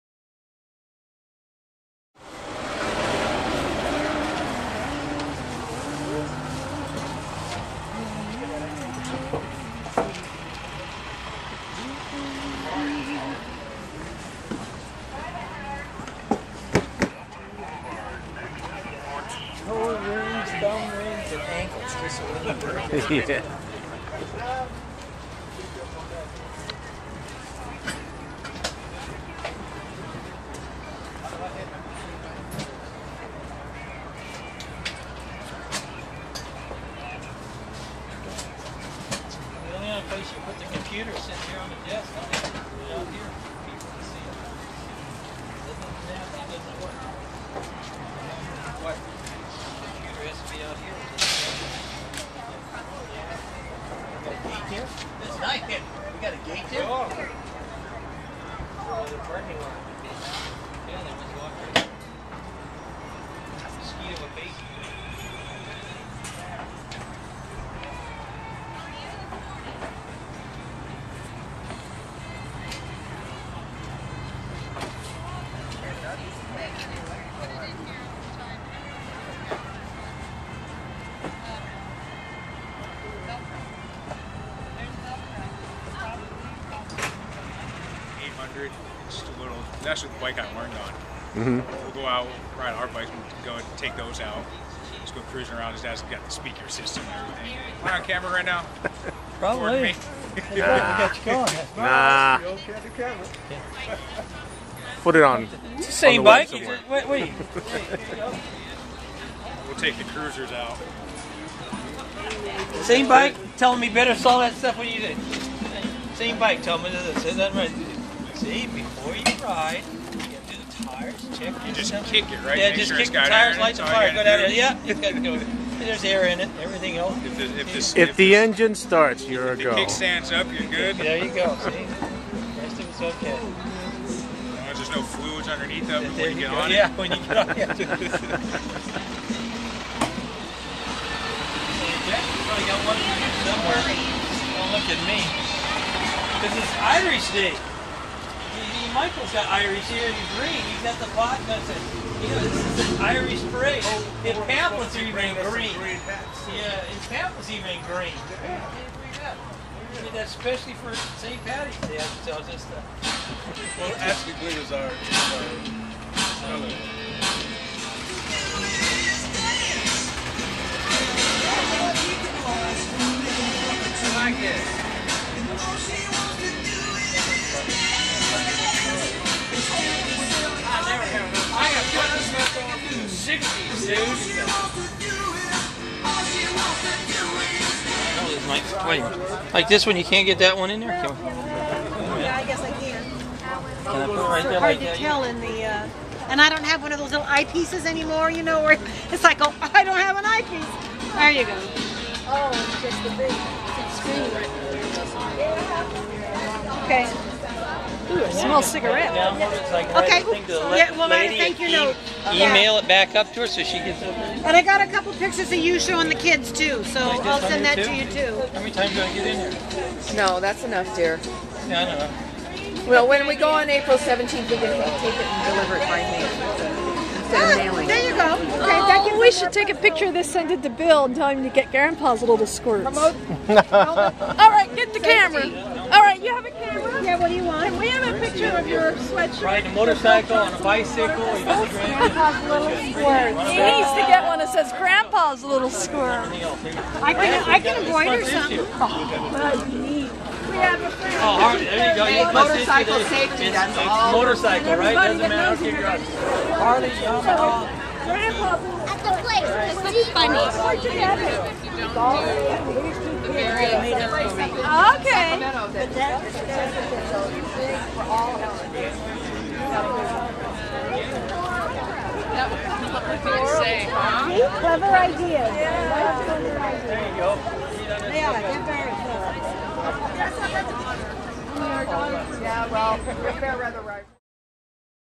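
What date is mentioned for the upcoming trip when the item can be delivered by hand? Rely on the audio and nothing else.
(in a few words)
April 17.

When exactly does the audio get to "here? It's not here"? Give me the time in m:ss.
0:54.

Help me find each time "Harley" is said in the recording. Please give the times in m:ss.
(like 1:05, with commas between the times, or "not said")
4:16.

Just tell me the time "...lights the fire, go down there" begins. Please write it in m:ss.
2:03.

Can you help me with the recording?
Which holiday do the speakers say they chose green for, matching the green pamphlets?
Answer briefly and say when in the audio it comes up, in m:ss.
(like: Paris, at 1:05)
St. Patty's Day, at 2:40.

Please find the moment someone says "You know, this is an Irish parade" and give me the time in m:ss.
2:32.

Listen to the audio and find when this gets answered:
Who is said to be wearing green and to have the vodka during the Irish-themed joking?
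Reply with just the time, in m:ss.
2:28.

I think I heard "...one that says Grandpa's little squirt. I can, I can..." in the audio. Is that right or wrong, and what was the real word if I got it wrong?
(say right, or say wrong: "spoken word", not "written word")
right.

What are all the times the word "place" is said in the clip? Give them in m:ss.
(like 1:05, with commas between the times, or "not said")
0:40, 4:19.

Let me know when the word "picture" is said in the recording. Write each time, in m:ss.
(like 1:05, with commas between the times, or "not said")
3:35, 3:49, 3:58.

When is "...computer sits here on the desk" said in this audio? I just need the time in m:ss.
0:40.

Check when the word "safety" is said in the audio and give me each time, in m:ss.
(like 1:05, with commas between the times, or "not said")
3:54, 4:13.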